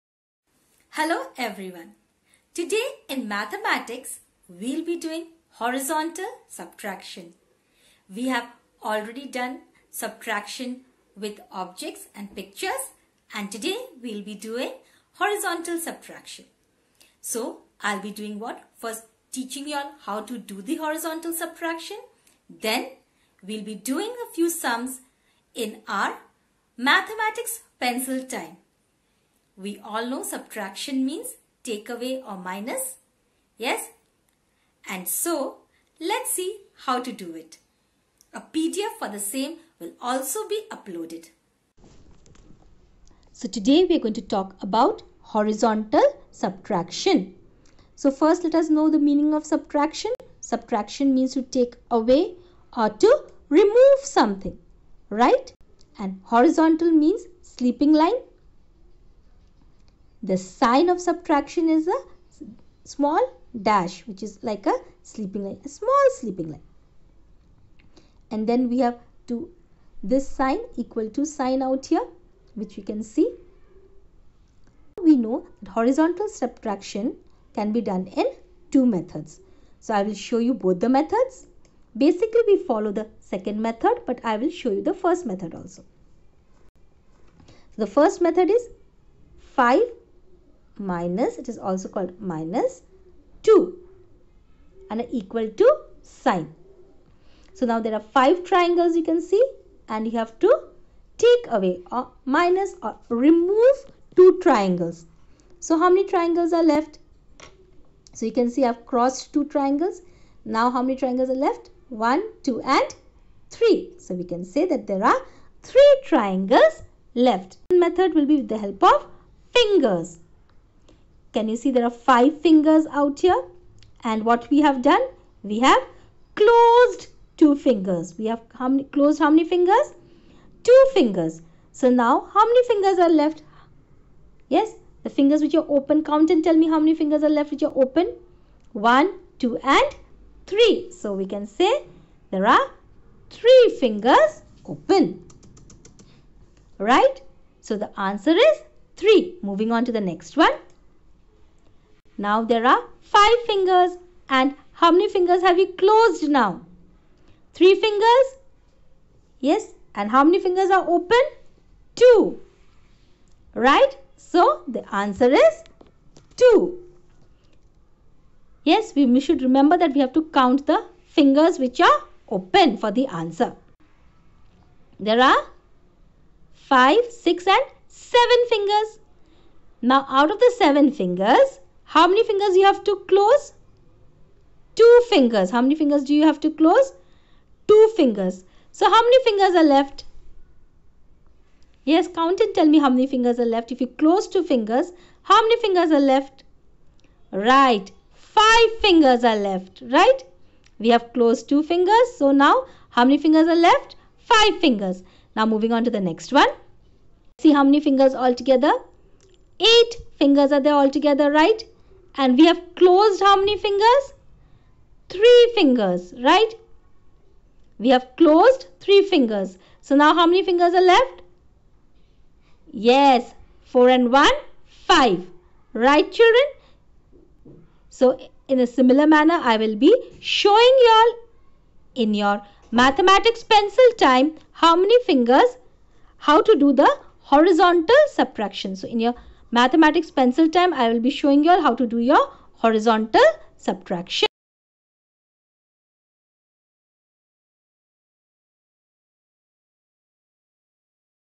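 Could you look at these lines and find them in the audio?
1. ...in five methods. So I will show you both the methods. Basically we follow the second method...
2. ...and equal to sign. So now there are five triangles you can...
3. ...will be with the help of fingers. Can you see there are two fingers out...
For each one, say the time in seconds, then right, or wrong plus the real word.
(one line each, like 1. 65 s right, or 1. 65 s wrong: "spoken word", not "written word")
1. 78 s wrong: "two", not "five"
2. 94 s right
3. 118 s wrong: "five", not "two".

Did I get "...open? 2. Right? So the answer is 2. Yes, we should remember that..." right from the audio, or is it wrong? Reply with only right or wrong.
right.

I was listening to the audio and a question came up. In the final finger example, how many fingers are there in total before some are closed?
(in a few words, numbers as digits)
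8.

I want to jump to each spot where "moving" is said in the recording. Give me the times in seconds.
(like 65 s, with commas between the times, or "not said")
149 s, 205 s.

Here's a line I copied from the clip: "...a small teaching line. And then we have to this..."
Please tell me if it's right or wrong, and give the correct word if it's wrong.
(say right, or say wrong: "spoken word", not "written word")
wrong: "sleeping", not "teaching".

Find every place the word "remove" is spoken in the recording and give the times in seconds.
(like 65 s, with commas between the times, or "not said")
53 s, 103 s.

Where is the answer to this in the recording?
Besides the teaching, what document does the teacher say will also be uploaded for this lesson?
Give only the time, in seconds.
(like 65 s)
38 s.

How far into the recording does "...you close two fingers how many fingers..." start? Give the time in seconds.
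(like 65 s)
193 s.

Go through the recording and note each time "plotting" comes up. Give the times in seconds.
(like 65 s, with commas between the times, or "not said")
not said.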